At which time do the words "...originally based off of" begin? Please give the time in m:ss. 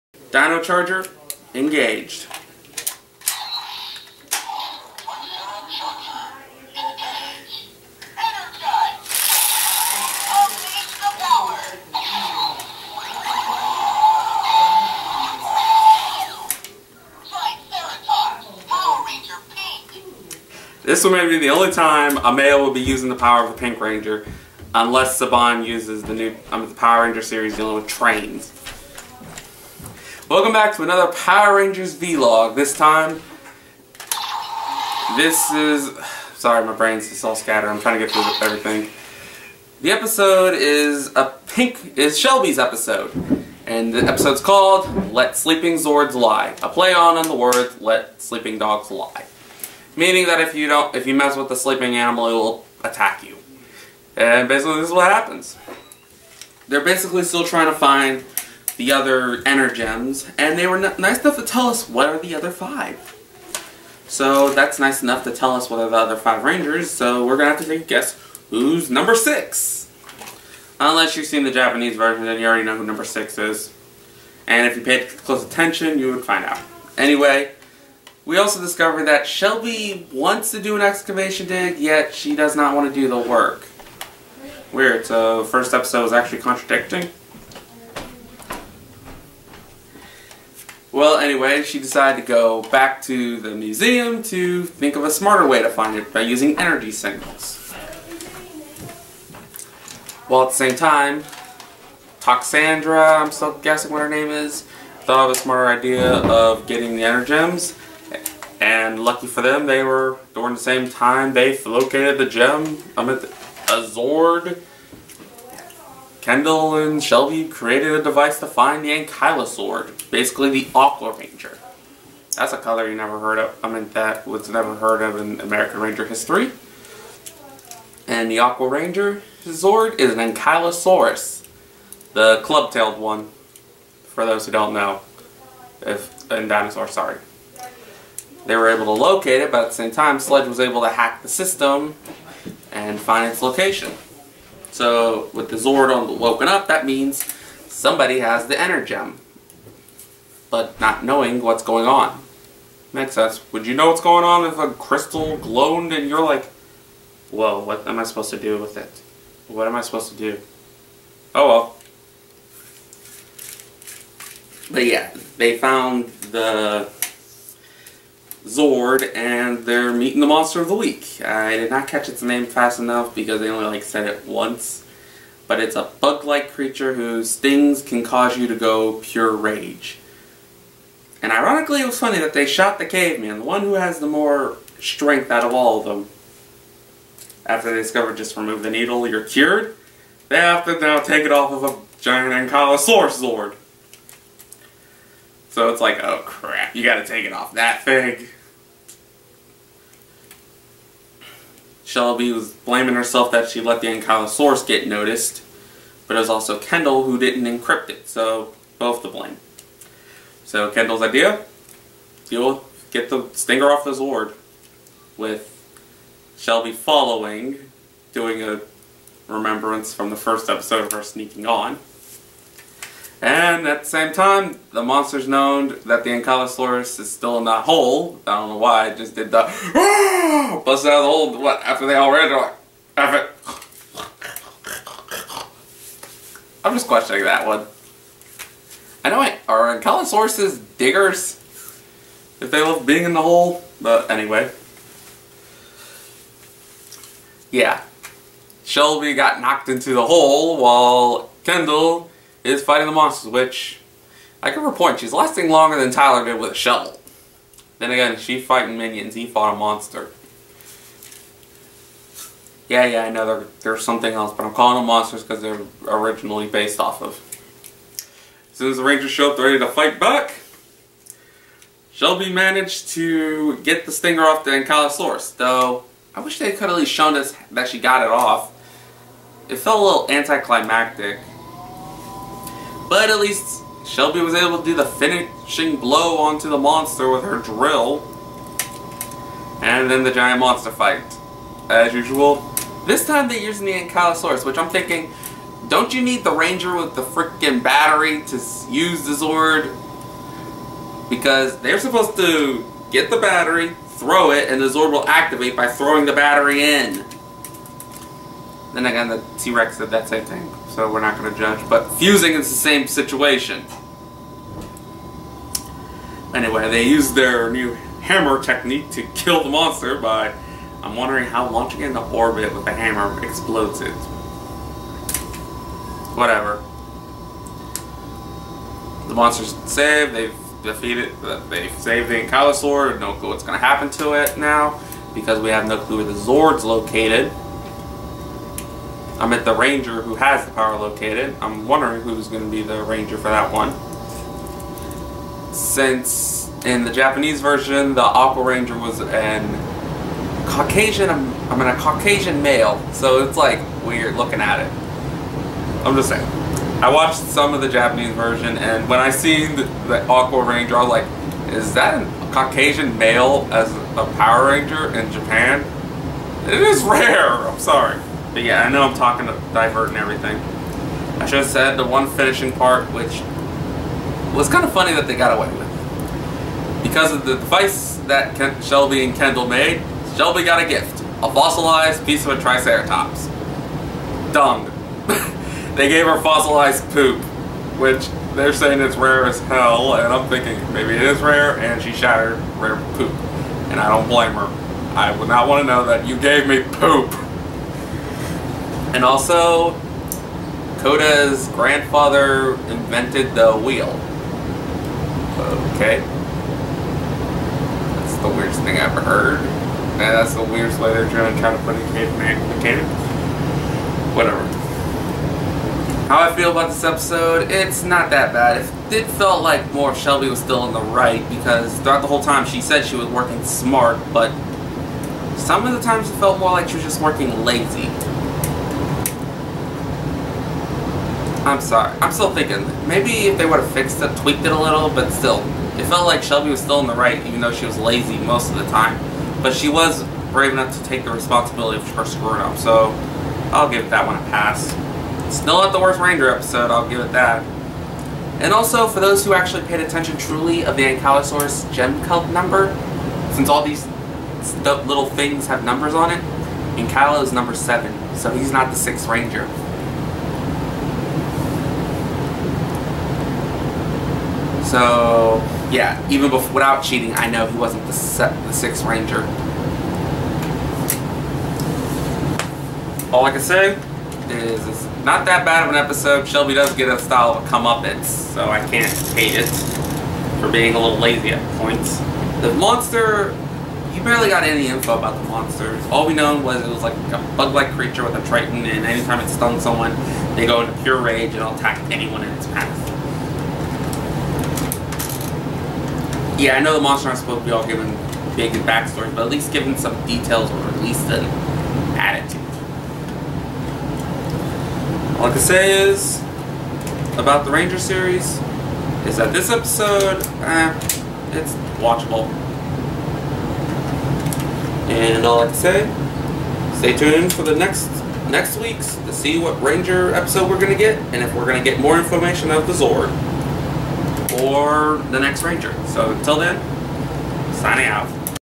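4:25.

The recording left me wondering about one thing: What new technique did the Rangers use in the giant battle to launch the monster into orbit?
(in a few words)
Hammer technique.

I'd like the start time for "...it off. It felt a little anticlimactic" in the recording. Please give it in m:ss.
4:38.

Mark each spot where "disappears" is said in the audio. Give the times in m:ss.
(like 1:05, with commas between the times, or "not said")
not said.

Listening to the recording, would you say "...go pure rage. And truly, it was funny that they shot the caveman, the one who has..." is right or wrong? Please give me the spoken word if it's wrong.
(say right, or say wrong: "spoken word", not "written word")
wrong: "ironically", not "truly".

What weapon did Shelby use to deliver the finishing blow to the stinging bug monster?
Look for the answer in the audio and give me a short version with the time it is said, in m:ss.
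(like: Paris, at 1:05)
Her drill, at 4:47.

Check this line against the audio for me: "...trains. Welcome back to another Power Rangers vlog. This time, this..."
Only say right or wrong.
right.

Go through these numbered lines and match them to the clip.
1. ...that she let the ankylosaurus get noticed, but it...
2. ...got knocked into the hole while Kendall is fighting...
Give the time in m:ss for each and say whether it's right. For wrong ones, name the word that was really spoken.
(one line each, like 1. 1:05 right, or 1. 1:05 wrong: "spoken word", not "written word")
1. 3:23 right
2. 4:09 right.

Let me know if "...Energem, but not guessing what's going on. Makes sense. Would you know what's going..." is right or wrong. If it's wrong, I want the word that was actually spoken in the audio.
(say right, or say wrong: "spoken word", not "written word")
wrong: "knowing", not "guessing".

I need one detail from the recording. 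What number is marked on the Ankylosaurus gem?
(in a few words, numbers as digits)
7.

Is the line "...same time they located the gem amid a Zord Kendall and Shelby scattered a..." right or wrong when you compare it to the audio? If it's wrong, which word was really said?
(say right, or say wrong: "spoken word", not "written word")
wrong: "created", not "scattered".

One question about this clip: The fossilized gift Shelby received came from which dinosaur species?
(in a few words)
Triceratops.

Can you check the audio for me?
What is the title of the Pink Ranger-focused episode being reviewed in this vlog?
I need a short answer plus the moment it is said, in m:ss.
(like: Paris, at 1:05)
Let Sleeping Zords Lie, at 0:45.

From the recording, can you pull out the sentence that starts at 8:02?
The monster, you barely got any info about the monsters.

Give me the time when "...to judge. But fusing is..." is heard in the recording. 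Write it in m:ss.
5:11.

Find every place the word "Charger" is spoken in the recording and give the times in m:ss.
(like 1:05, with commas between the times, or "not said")
0:00.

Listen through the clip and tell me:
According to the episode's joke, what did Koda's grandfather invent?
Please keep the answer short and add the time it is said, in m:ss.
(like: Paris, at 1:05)
The wheel, at 6:43.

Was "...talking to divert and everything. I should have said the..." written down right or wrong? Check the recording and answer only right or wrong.
right.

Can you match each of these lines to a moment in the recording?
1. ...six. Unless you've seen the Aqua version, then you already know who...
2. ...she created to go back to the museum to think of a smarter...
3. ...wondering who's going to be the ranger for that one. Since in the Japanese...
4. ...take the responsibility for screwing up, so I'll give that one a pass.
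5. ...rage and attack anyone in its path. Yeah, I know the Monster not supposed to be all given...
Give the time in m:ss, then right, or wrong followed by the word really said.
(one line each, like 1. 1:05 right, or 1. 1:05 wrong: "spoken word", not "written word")
1. 1:09 wrong: "Japanese", not "Aqua"
2. 1:31 wrong: "decided", not "created"
3. 5:41 right
4. 7:20 right
5. 8:11 right.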